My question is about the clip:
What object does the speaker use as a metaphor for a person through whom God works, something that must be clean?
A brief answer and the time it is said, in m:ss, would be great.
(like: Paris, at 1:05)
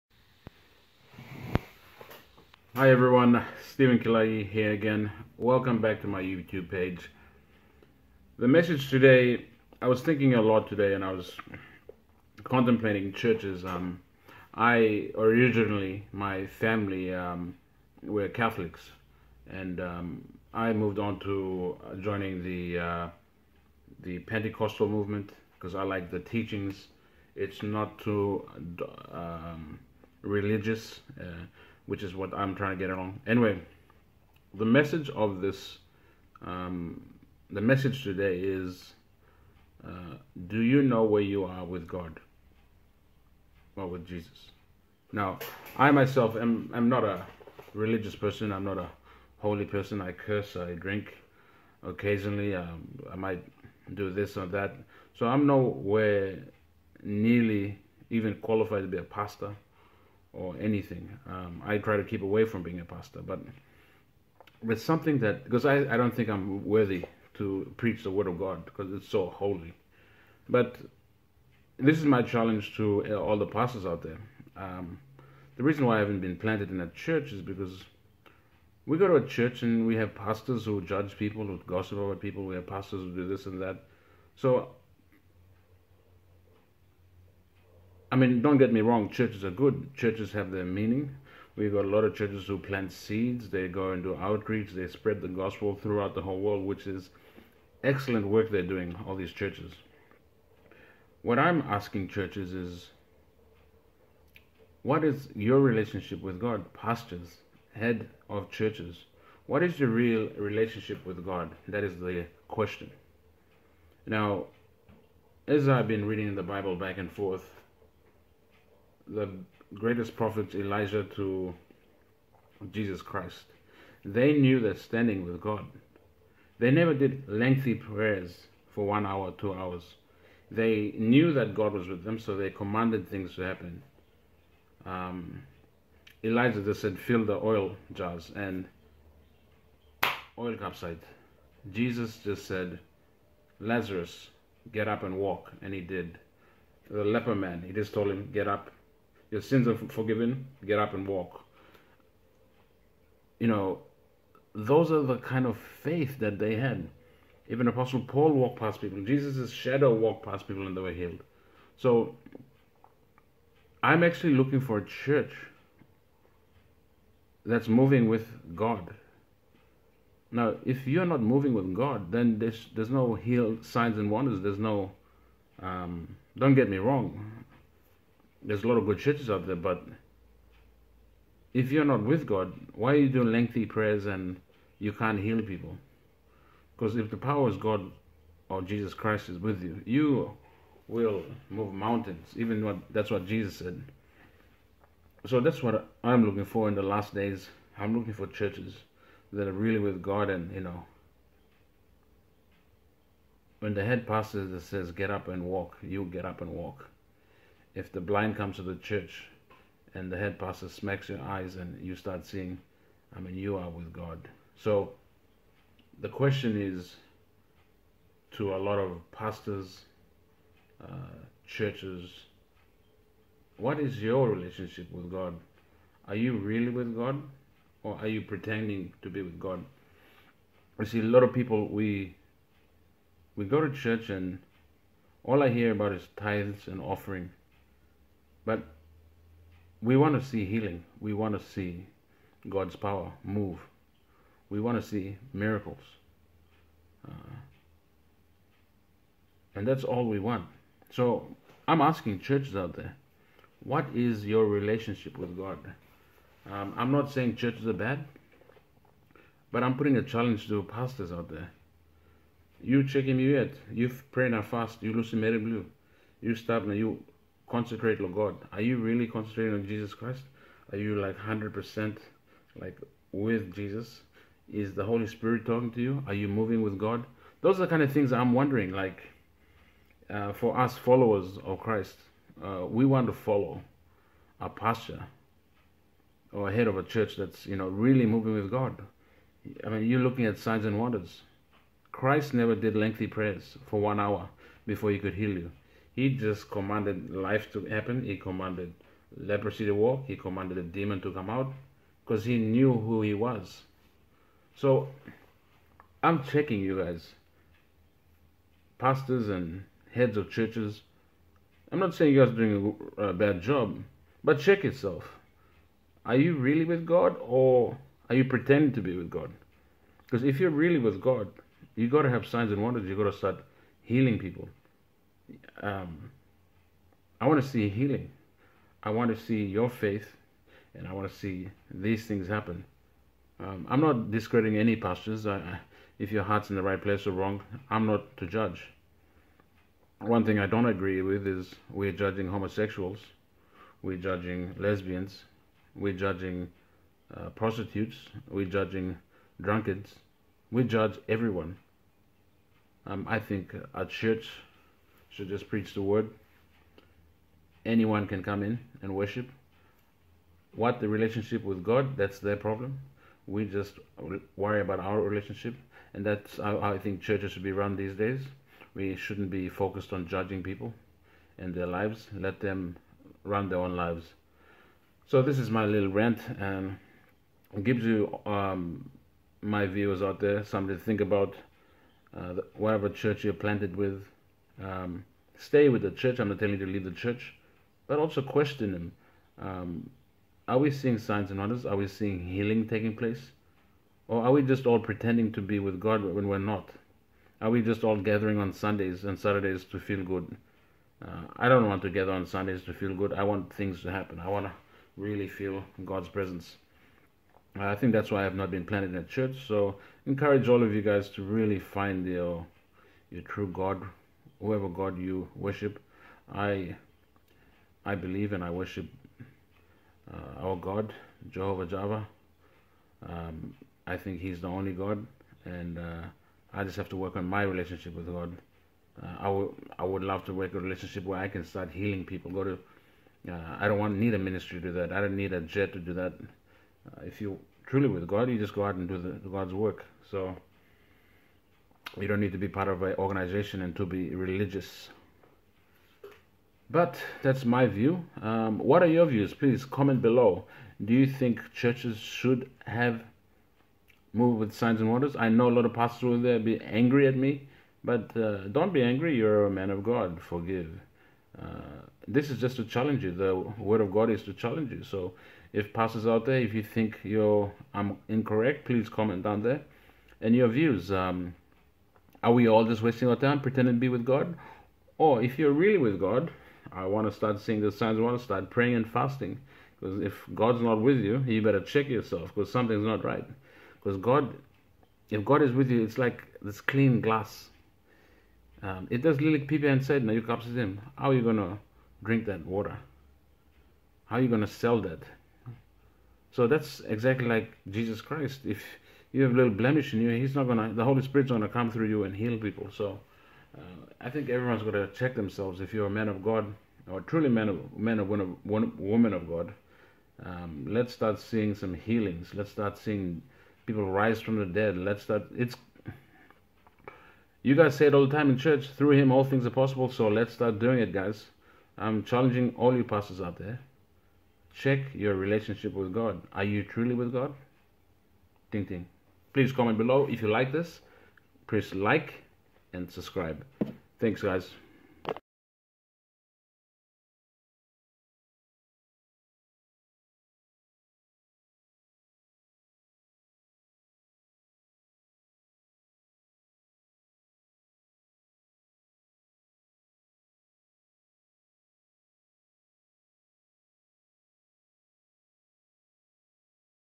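glass, at 8:06.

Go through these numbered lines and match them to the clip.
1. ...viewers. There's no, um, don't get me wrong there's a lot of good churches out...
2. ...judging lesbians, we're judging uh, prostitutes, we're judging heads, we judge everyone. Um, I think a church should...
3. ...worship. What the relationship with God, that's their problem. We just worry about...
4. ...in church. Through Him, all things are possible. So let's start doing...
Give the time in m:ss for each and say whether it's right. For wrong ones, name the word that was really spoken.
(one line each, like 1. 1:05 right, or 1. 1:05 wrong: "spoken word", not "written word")
1. 2:54 wrong: "wonders", not "viewers"
2. 5:43 wrong: "drunkards", not "heads"
3. 5:58 right
4. 8:38 right.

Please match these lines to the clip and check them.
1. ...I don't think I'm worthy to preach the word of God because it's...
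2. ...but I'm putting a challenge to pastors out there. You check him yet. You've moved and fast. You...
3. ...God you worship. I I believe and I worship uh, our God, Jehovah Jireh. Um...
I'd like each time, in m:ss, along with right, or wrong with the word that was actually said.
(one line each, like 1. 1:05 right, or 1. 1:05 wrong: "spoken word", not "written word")
1. 1:05 right
2. 4:19 wrong: "prayed", not "moved"
3. 6:54 right.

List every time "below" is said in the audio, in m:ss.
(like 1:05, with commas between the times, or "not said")
7:30, 8:49.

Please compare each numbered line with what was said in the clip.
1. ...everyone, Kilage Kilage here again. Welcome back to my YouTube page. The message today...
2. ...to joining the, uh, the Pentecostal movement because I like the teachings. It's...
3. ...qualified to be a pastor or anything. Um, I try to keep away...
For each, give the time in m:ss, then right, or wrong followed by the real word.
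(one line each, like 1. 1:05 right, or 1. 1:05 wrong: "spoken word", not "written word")
1. 0:02 wrong: "Steven", not "Kilage"
2. 0:21 right
3. 0:58 right.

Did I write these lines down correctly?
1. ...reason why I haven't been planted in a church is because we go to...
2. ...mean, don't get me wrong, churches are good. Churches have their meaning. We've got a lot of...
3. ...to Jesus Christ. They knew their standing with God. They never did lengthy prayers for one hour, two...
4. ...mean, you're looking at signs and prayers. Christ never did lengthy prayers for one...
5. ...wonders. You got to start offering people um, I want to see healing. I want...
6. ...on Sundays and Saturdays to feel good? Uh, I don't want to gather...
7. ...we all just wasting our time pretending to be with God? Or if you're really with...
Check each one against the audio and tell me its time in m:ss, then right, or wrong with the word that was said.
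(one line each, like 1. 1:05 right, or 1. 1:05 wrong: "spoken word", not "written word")
1. 1:15 right
2. 1:28 right
3. 2:01 right
4. 4:49 wrong: "wonders", not "prayers"
5. 5:22 wrong: "healing", not "offering"
6. 6:38 right
7. 7:52 right.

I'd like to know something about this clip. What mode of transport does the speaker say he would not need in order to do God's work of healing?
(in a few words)
a jet.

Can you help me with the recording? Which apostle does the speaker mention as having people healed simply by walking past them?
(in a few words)
Paul.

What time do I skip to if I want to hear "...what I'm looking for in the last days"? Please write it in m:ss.
3:15.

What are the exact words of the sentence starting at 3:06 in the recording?
Because if the power is God or Jesus Christ is with you, you will move mountains.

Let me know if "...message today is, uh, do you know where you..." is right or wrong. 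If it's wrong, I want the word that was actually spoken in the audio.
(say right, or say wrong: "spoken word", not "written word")
right.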